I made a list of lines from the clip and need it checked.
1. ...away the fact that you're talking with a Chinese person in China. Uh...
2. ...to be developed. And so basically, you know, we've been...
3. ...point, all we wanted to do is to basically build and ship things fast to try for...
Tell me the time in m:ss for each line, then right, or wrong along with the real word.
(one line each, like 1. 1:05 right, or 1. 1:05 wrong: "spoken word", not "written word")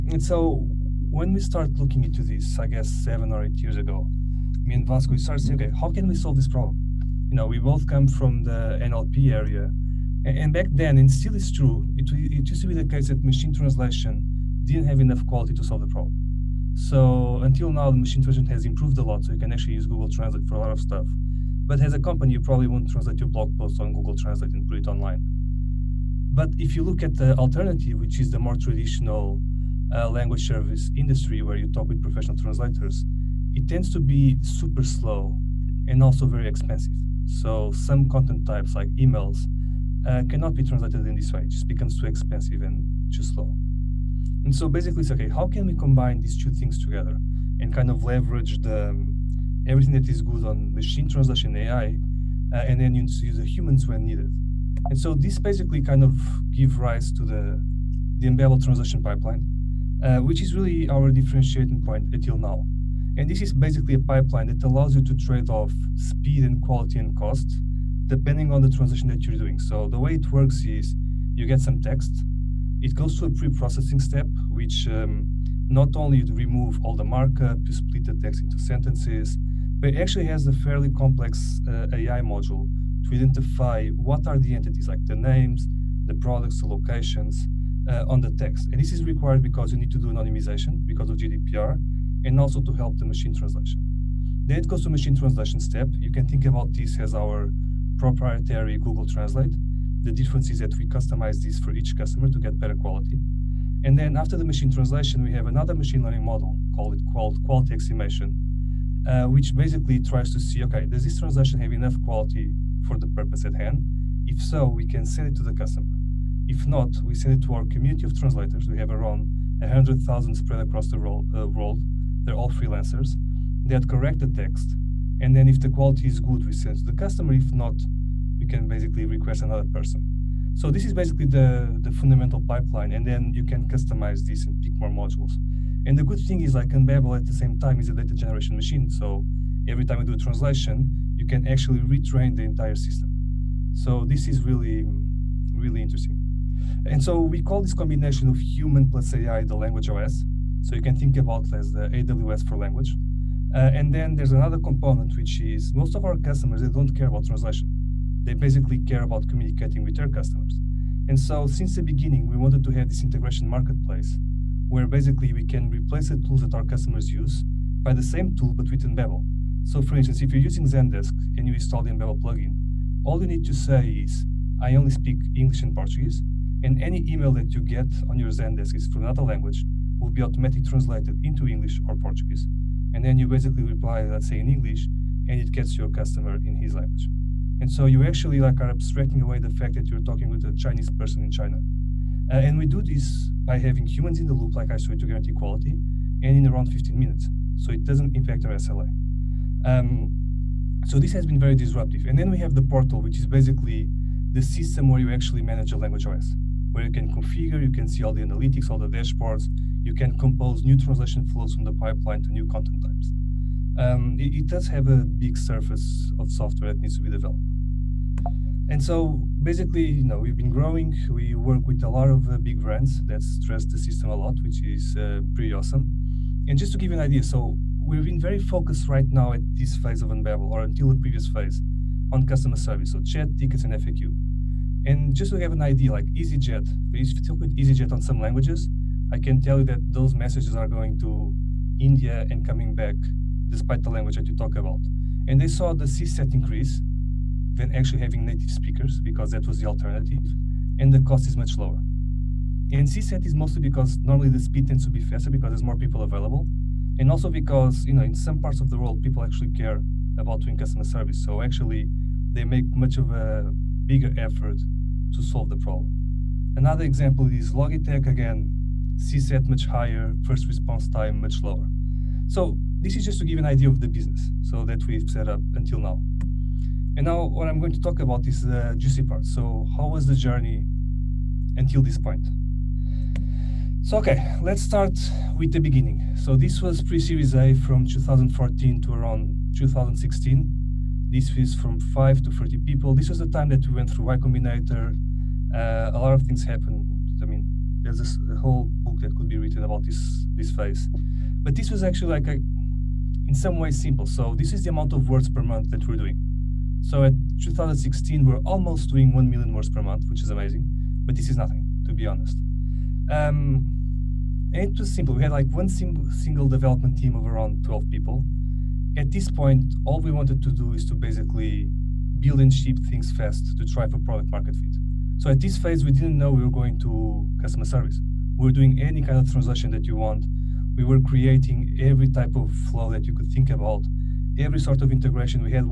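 1. 3:09 right
2. 3:36 right
3. 5:19 right.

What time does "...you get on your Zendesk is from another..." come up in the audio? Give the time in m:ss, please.
2:57.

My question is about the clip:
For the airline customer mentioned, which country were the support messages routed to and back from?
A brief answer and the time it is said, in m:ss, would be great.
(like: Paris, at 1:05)
India, at 4:01.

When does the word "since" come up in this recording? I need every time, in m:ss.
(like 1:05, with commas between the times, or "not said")
2:41.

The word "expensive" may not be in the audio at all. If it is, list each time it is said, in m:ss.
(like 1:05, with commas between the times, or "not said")
0:36, 0:42.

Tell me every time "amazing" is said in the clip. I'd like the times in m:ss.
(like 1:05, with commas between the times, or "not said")
5:10.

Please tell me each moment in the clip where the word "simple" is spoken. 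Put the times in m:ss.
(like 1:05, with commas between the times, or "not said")
5:03, 5:14.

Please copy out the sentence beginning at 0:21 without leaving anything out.
But as a company, you probably won't translate your blog post on Google Translate and put it online.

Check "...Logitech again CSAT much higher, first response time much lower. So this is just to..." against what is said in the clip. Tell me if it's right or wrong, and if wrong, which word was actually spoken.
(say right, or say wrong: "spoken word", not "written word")
right.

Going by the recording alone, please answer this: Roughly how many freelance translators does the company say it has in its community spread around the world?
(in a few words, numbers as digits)
100,000.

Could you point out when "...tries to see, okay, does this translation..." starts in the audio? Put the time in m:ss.
1:50.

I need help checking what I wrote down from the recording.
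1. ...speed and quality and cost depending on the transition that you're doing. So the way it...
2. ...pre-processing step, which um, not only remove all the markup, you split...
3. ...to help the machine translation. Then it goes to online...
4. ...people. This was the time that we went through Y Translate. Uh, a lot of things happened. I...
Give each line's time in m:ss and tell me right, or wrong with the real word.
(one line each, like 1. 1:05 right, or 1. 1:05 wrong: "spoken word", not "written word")
1. 1:05 right
2. 1:13 right
3. 1:32 wrong: "machine", not "online"
4. 4:52 wrong: "Combinator", not "Translate".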